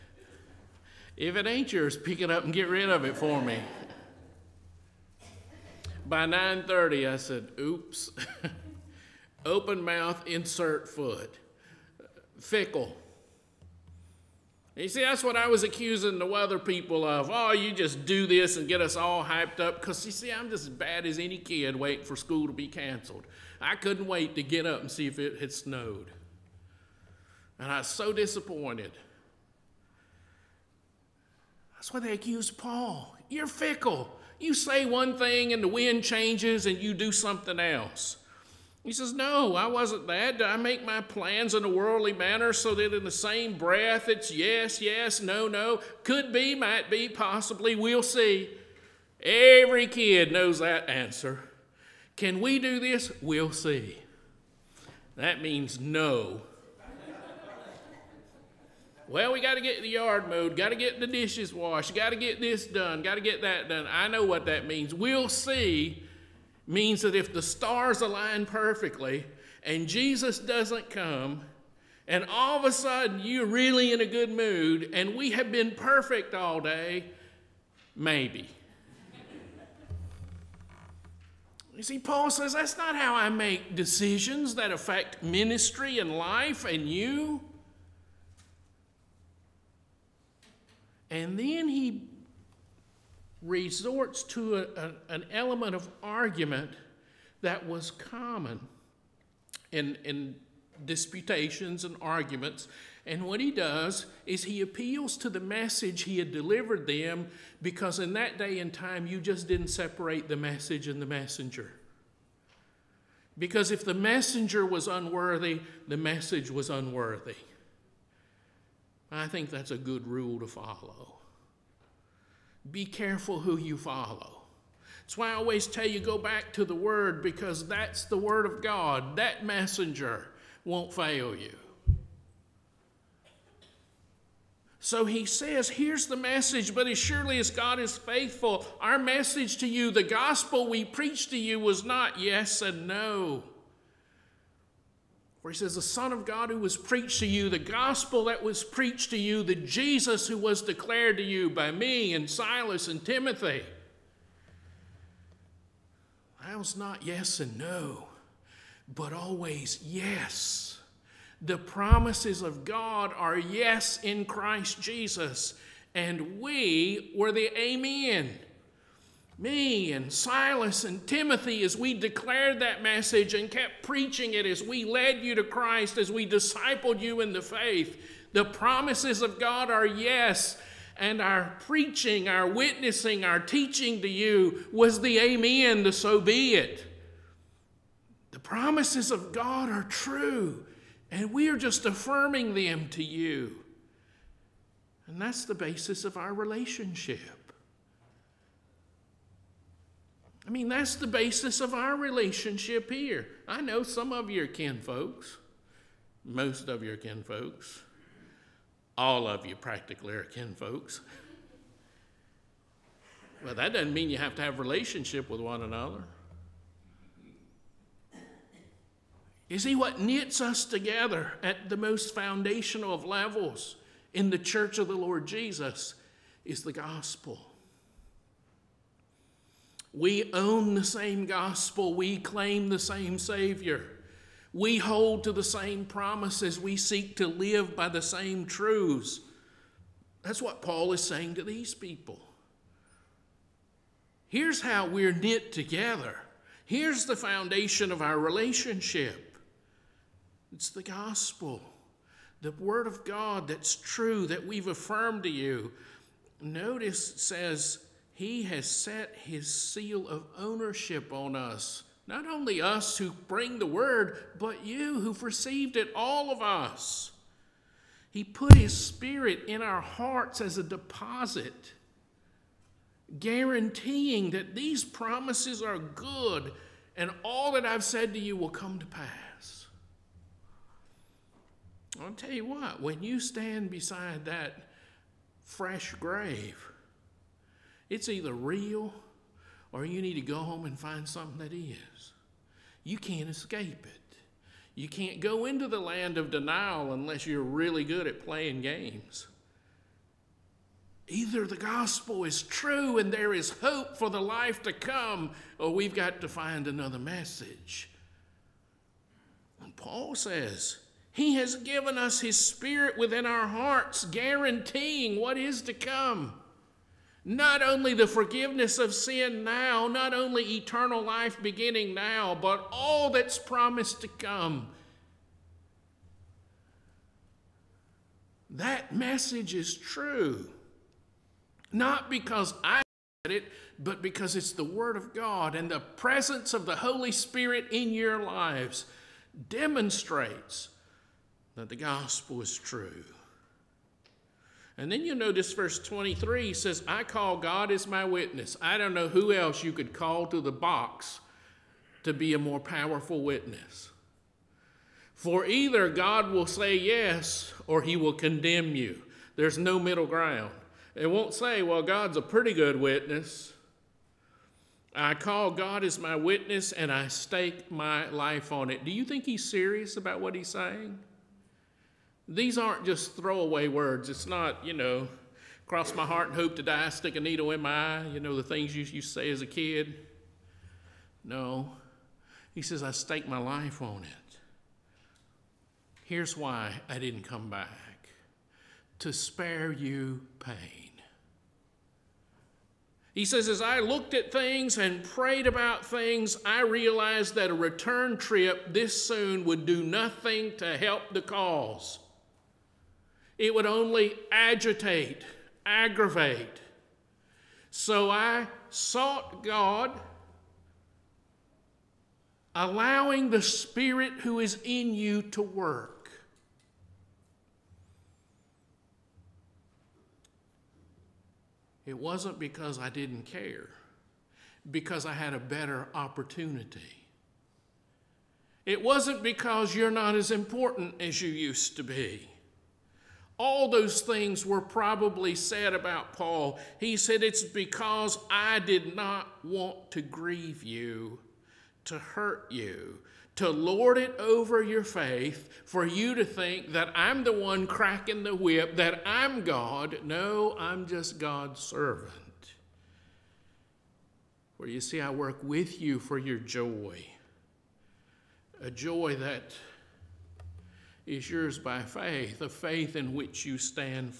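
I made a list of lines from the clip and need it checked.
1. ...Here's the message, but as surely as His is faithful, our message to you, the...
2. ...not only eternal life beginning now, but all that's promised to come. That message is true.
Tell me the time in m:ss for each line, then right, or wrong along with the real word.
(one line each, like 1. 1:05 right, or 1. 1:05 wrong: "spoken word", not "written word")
1. 2:15 wrong: "God", not "His"
2. 5:19 right.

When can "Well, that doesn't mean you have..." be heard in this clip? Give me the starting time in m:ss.
3:33.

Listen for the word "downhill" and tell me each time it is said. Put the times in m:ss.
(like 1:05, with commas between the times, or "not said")
not said.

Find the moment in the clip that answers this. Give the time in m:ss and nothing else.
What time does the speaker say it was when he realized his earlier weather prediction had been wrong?
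0:06.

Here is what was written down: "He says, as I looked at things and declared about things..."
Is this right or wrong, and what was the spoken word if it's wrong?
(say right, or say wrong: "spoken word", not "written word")
wrong: "prayed", not "declared".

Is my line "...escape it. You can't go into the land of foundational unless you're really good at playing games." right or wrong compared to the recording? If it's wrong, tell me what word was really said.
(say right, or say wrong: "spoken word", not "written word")
wrong: "denial", not "foundational".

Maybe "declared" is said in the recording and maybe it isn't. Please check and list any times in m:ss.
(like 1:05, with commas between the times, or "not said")
2:30, 2:51.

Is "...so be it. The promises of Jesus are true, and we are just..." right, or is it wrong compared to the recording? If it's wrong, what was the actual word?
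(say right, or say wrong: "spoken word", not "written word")
wrong: "God", not "Jesus".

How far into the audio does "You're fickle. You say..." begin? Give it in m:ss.
0:33.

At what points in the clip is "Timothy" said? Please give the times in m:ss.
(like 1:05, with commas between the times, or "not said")
2:33, 2:51.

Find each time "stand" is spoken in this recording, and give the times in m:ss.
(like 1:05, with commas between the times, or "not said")
4:43, 7:43.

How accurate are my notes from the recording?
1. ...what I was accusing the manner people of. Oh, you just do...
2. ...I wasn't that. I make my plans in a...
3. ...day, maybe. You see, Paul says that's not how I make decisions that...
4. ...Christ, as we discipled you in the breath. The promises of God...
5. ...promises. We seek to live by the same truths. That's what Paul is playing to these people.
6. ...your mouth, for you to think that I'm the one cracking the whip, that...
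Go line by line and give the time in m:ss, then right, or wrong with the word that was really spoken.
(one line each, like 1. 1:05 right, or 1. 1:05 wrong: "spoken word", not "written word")
1. 0:15 wrong: "weather", not "manner"
2. 0:39 right
3. 1:16 right
4. 2:55 wrong: "faith", not "breath"
5. 3:55 wrong: "saying", not "playing"
6. 7:24 wrong: "faith", not "mouth".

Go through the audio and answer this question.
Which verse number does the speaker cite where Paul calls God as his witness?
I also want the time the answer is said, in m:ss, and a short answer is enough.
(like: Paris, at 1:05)
23, at 5:45.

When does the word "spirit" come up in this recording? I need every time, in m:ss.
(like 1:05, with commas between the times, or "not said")
4:28, 5:12, 5:37, 6:53.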